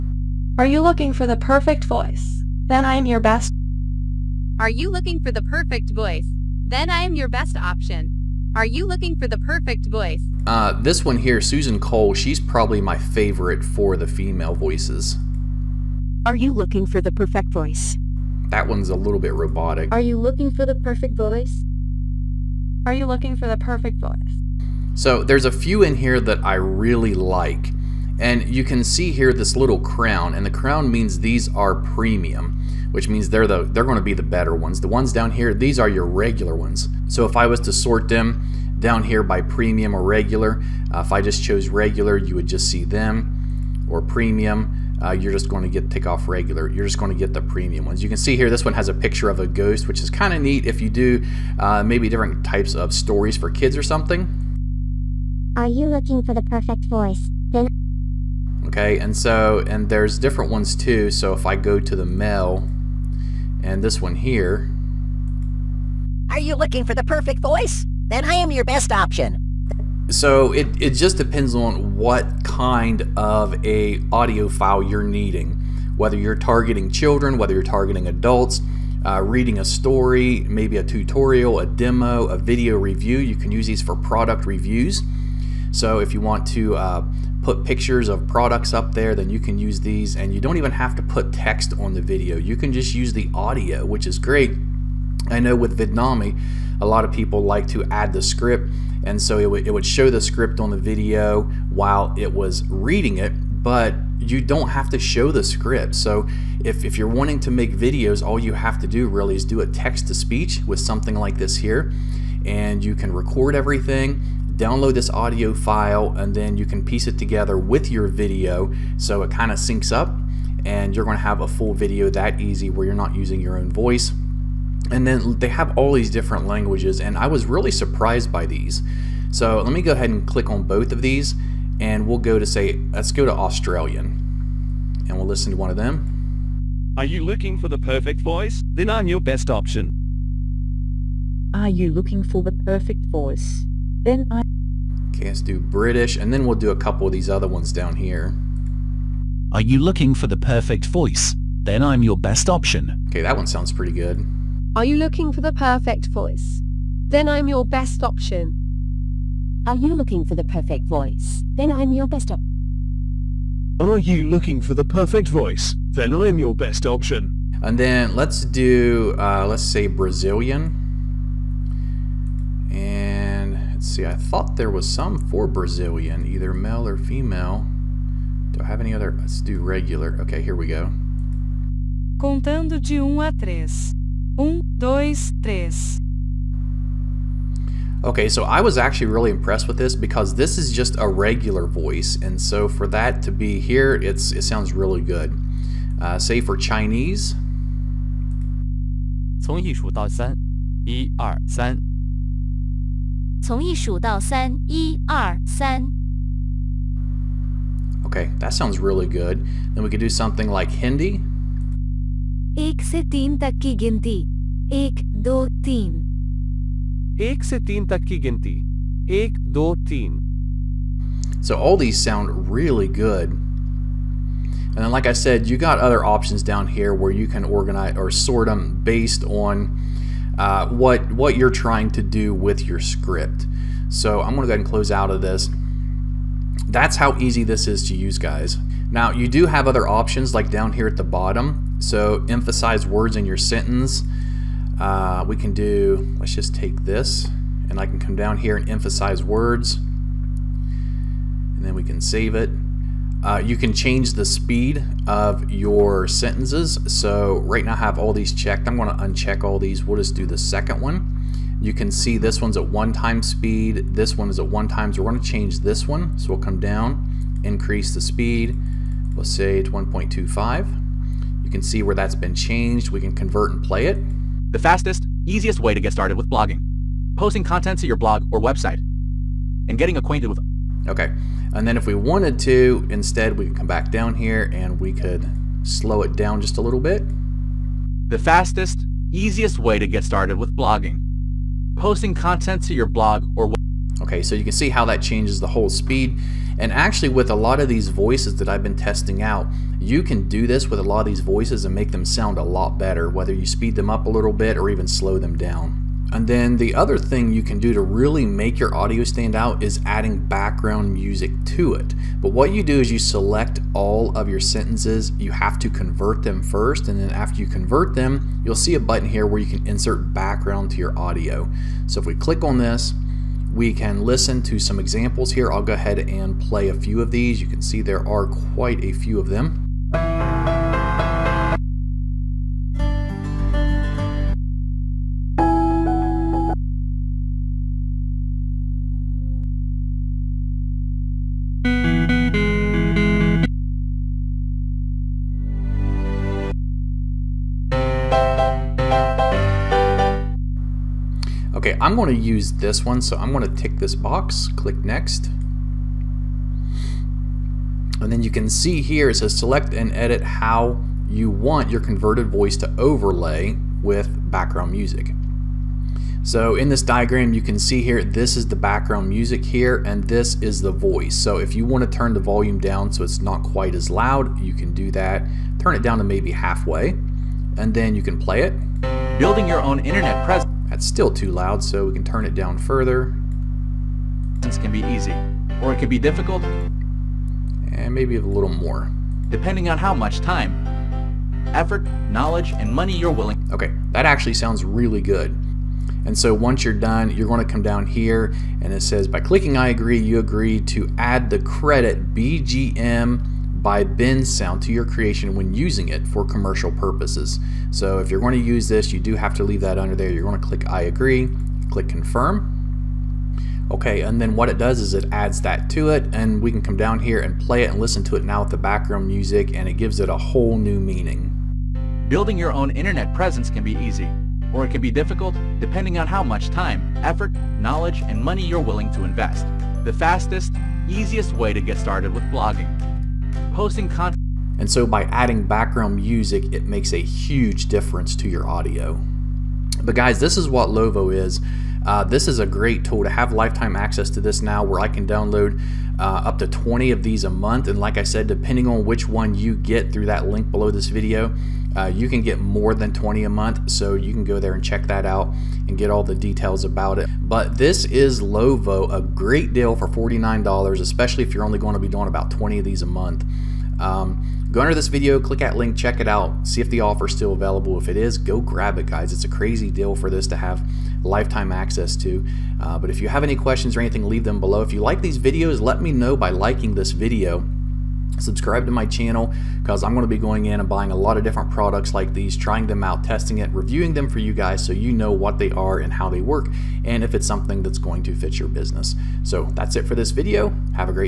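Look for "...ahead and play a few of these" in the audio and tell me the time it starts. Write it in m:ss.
5:25.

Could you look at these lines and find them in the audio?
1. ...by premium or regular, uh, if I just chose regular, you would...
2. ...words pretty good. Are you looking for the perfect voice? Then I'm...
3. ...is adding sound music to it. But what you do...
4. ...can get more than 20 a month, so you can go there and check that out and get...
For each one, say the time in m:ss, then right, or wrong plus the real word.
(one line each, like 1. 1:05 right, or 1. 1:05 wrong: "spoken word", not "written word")
1. 0:39 right
2. 2:33 wrong: "sounds", not "words"
3. 5:09 wrong: "background", not "sound"
4. 7:32 right.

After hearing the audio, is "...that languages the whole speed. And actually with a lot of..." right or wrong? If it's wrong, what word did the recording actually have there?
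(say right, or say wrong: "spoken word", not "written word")
wrong: "changes", not "languages".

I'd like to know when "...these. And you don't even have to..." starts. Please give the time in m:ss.
1:29.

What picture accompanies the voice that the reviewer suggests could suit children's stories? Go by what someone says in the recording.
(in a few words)
ghost.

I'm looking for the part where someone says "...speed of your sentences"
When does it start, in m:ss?
4:14.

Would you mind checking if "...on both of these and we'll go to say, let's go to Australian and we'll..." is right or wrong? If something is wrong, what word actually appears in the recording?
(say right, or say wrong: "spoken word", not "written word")
right.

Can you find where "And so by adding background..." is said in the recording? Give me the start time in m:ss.
7:14.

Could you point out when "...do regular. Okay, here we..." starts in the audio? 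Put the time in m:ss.
2:59.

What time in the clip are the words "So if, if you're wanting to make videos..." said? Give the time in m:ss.
1:45.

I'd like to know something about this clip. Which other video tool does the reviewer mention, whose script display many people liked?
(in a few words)
Vidnami.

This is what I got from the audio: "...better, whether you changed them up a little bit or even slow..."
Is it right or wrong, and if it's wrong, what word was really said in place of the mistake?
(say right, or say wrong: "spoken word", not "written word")
wrong: "speed", not "changed".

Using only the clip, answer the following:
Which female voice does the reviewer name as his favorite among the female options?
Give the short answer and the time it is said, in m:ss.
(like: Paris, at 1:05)
Susan Cole, at 0:11.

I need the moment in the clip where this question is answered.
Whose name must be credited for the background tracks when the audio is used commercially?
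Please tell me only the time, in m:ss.
6:43.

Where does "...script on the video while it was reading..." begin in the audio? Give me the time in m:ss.
1:40.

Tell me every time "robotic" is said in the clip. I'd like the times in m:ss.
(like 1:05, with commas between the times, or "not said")
0:19.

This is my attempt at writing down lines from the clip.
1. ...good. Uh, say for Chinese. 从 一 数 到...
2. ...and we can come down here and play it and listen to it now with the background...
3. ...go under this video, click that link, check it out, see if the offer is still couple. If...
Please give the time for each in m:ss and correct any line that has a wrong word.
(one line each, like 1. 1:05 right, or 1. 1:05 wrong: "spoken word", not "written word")
1. 3:14 right
2. 6:56 right
3. 7:44 wrong: "available", not "couple".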